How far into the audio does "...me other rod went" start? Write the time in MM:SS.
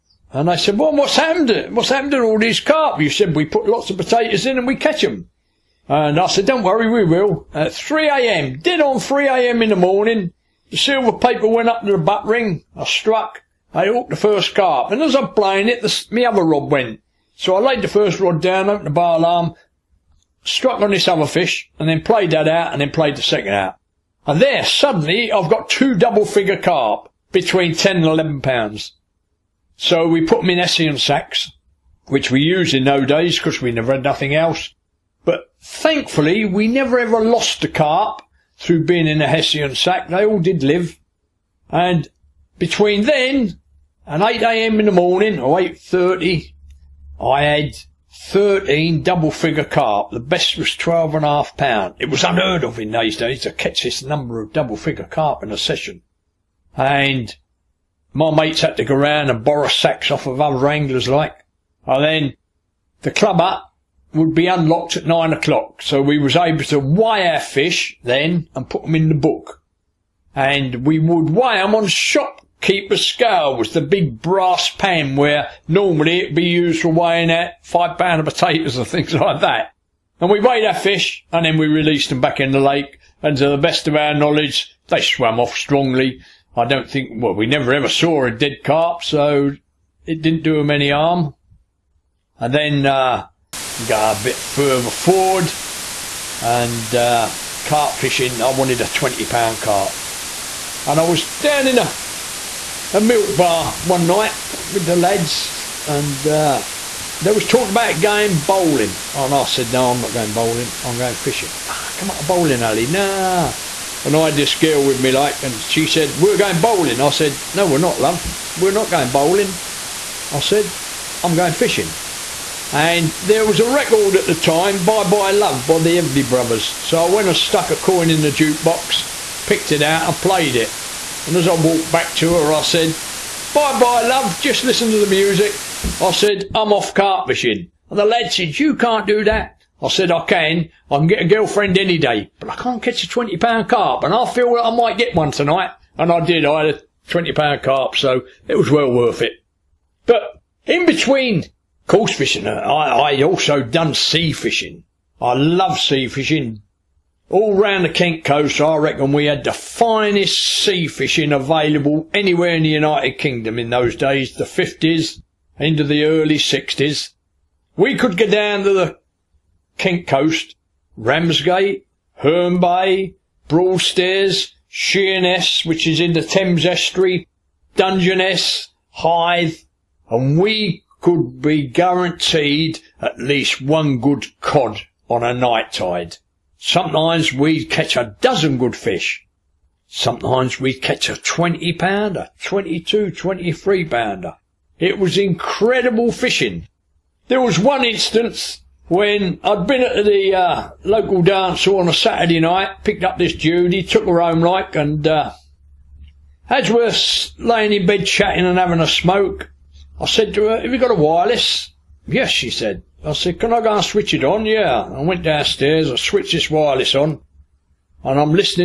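00:16.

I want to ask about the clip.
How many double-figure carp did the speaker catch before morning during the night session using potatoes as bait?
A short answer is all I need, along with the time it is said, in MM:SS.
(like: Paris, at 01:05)
13, at 00:48.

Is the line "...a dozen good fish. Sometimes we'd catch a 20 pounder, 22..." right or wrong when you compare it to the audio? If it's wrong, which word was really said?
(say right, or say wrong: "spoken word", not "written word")
right.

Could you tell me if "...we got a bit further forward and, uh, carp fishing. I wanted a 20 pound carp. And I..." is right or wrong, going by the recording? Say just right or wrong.
right.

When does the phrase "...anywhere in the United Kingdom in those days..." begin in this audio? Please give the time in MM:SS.
02:42.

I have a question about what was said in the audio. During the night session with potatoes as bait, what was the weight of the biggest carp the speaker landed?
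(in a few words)
12 and a half pounds.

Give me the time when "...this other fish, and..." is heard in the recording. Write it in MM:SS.
00:20.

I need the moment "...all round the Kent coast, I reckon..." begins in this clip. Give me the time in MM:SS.
02:37.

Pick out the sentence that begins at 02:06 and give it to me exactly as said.
So I went and stuck a coin in the jukebox, picked it out and played it.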